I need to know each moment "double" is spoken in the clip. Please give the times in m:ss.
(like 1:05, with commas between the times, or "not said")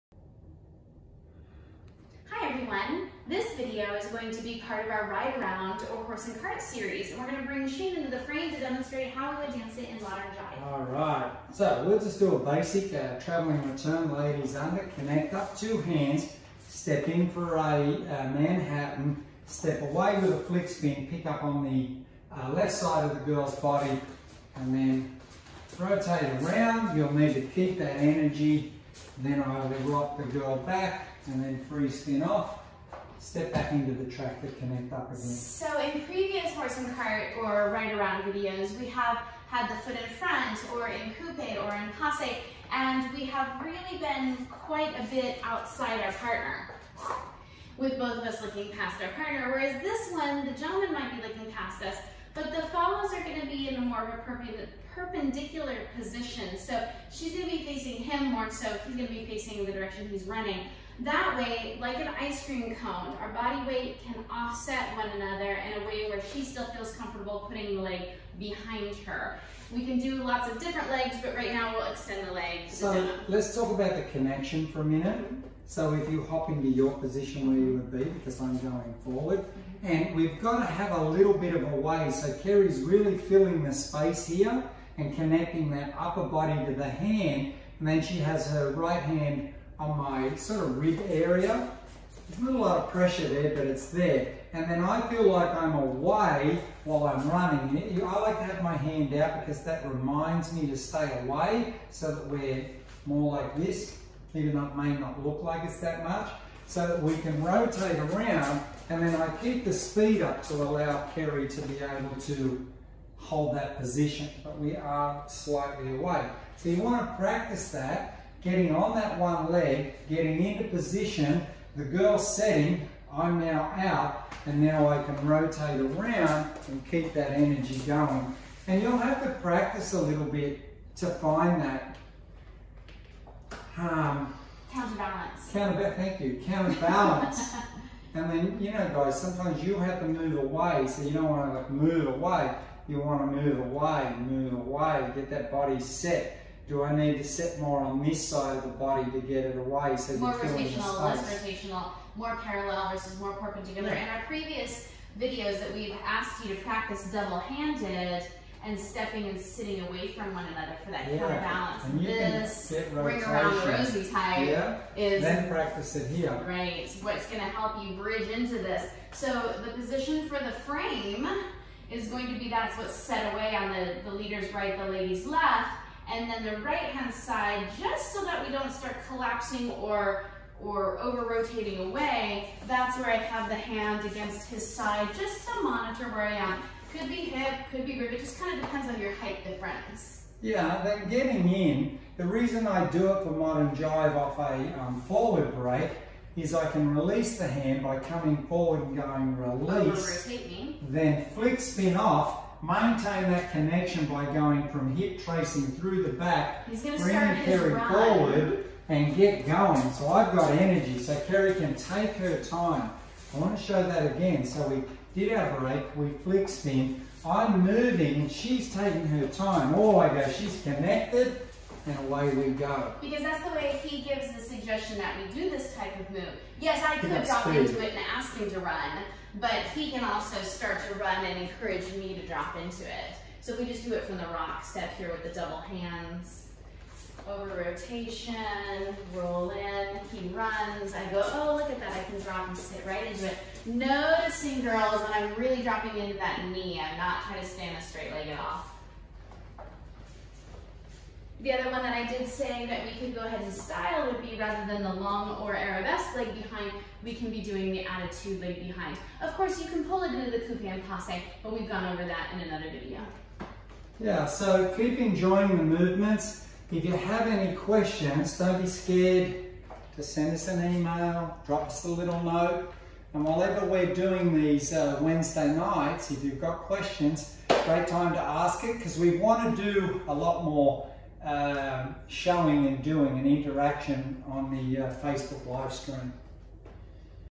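2:37, 3:55.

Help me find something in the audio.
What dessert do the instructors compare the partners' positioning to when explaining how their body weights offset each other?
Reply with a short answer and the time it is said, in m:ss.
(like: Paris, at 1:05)
Ice cream cone, at 1:02.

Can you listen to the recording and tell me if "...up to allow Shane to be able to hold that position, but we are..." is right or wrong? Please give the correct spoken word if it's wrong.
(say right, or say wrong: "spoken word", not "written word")
wrong: "Keri", not "Shane".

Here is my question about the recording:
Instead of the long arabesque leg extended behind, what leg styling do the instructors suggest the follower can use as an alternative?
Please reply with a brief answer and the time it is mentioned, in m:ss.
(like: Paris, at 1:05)
Attitude leg, at 4:17.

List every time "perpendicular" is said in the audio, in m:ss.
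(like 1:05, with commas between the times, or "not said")
0:54, 2:33.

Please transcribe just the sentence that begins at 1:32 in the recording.
There's not a lot of pressure there, but it's there.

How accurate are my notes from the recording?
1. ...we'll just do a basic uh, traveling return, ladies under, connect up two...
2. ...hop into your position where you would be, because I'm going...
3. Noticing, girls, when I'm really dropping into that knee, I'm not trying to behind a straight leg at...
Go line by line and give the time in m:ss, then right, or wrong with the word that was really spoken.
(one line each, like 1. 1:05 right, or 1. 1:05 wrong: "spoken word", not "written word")
1. 0:11 right
2. 1:16 right
3. 4:03 wrong: "stand", not "behind".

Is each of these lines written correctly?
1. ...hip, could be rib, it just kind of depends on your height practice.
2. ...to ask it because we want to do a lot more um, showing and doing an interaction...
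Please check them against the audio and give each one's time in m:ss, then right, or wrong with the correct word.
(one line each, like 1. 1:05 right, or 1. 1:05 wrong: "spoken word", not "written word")
1. 3:07 wrong: "difference", not "practice"
2. 4:38 right.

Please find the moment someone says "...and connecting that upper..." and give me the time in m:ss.
1:24.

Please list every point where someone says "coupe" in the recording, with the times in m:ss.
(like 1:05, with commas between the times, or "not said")
0:41, 4:20.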